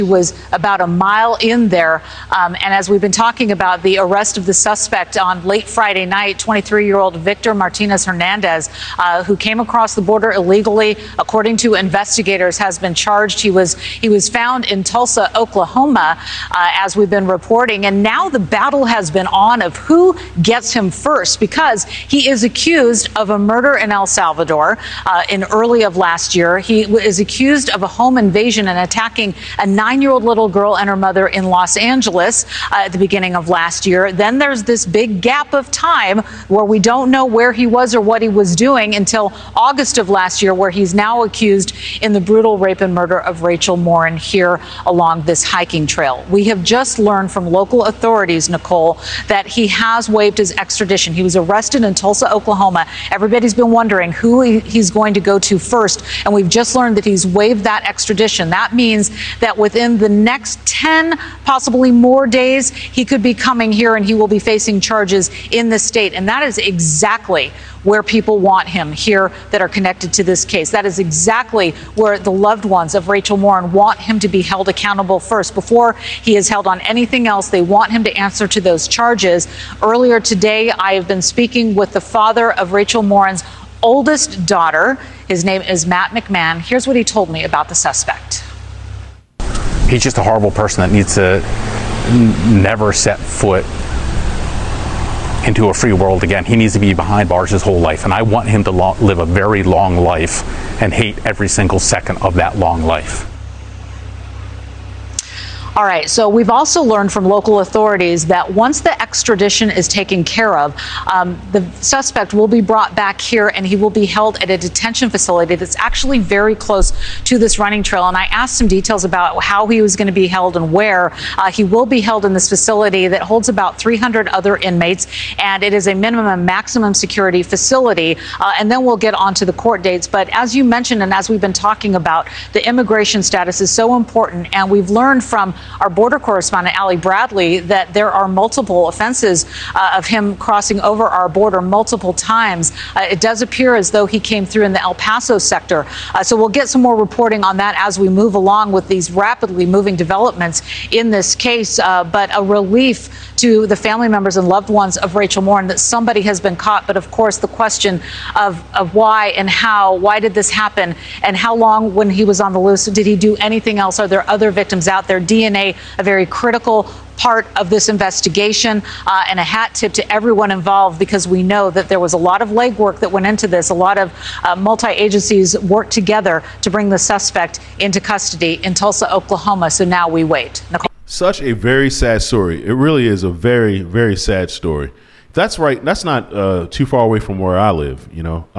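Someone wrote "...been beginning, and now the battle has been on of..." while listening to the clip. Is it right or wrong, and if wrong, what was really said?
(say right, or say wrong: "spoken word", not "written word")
wrong: "reporting", not "beginning".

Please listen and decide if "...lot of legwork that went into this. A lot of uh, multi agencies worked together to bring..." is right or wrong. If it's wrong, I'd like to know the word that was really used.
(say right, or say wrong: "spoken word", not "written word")
right.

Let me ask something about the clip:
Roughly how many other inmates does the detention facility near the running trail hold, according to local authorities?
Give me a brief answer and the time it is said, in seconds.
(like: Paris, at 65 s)
300, at 123 s.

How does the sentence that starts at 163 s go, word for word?
Are there other victims out there?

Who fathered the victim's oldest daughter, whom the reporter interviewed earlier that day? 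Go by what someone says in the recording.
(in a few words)
Matt McMahon.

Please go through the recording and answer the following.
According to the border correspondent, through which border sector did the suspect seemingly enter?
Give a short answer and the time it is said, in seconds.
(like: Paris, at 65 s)
El Paso, at 144 s.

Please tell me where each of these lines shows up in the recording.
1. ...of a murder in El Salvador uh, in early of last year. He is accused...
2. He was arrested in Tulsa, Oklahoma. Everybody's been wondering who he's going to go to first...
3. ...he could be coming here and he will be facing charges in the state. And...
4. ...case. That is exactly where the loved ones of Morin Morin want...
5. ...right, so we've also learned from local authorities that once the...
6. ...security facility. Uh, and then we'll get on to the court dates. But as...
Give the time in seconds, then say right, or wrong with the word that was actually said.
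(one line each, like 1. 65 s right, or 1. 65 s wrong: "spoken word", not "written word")
1. 23 s right
2. 51 s right
3. 62 s right
4. 70 s wrong: "Rachel", not "Morin"
5. 105 s right
6. 126 s right.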